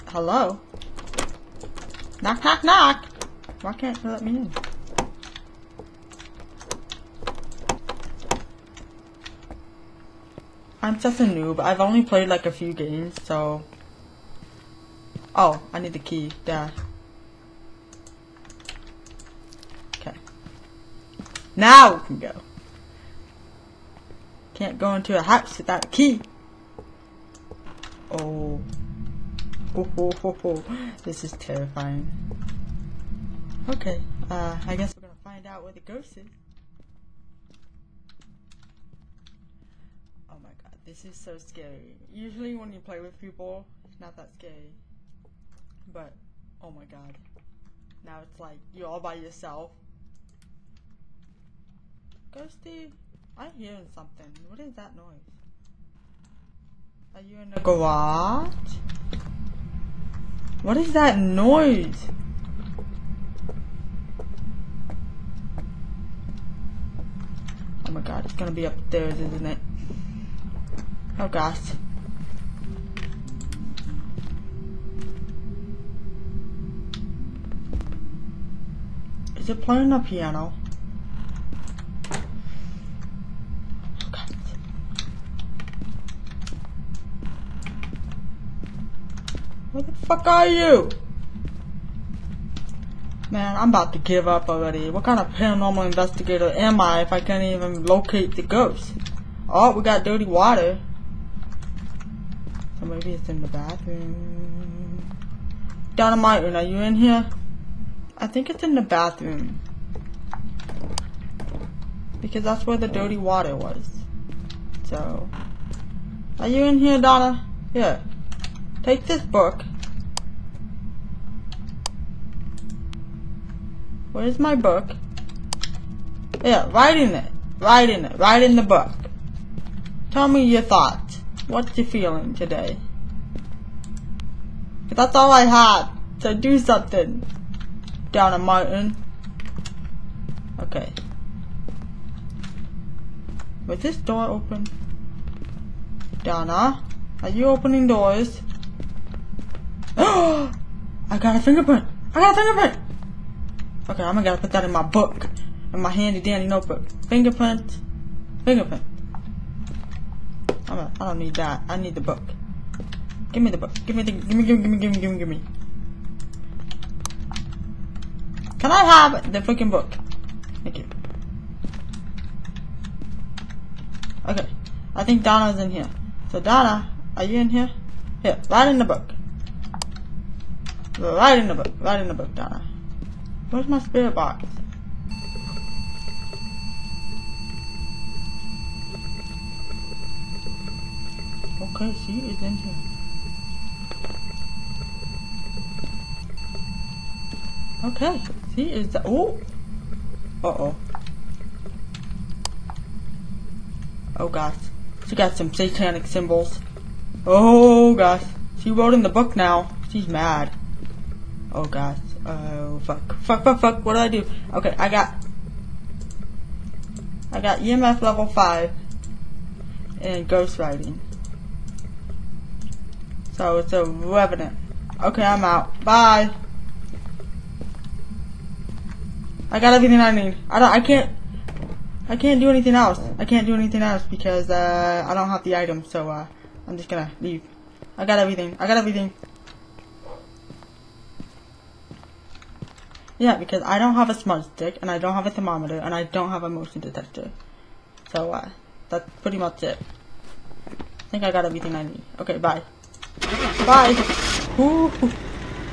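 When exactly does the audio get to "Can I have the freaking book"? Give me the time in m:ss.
2:48.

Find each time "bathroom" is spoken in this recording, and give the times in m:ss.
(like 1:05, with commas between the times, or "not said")
1:43, 1:48.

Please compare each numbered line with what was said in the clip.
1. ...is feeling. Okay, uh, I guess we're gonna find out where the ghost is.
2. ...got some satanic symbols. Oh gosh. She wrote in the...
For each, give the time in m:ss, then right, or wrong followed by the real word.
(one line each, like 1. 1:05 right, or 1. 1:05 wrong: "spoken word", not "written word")
1. 0:31 wrong: "terrifying", not "feeling"
2. 3:25 right.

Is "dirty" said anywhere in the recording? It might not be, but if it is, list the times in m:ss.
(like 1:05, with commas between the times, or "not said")
1:40, 1:52.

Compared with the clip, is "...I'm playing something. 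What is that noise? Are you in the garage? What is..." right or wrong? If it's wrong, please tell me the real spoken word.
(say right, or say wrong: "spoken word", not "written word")
wrong: "hearing", not "playing".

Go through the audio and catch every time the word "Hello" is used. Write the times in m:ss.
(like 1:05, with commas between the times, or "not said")
0:00.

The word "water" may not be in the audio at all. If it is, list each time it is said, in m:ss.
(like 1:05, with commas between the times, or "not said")
1:40, 1:53.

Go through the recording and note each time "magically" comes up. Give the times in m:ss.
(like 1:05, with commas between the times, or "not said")
not said.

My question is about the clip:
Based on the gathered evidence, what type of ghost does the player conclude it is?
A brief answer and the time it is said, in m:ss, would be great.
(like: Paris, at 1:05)
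revenant, at 3:43.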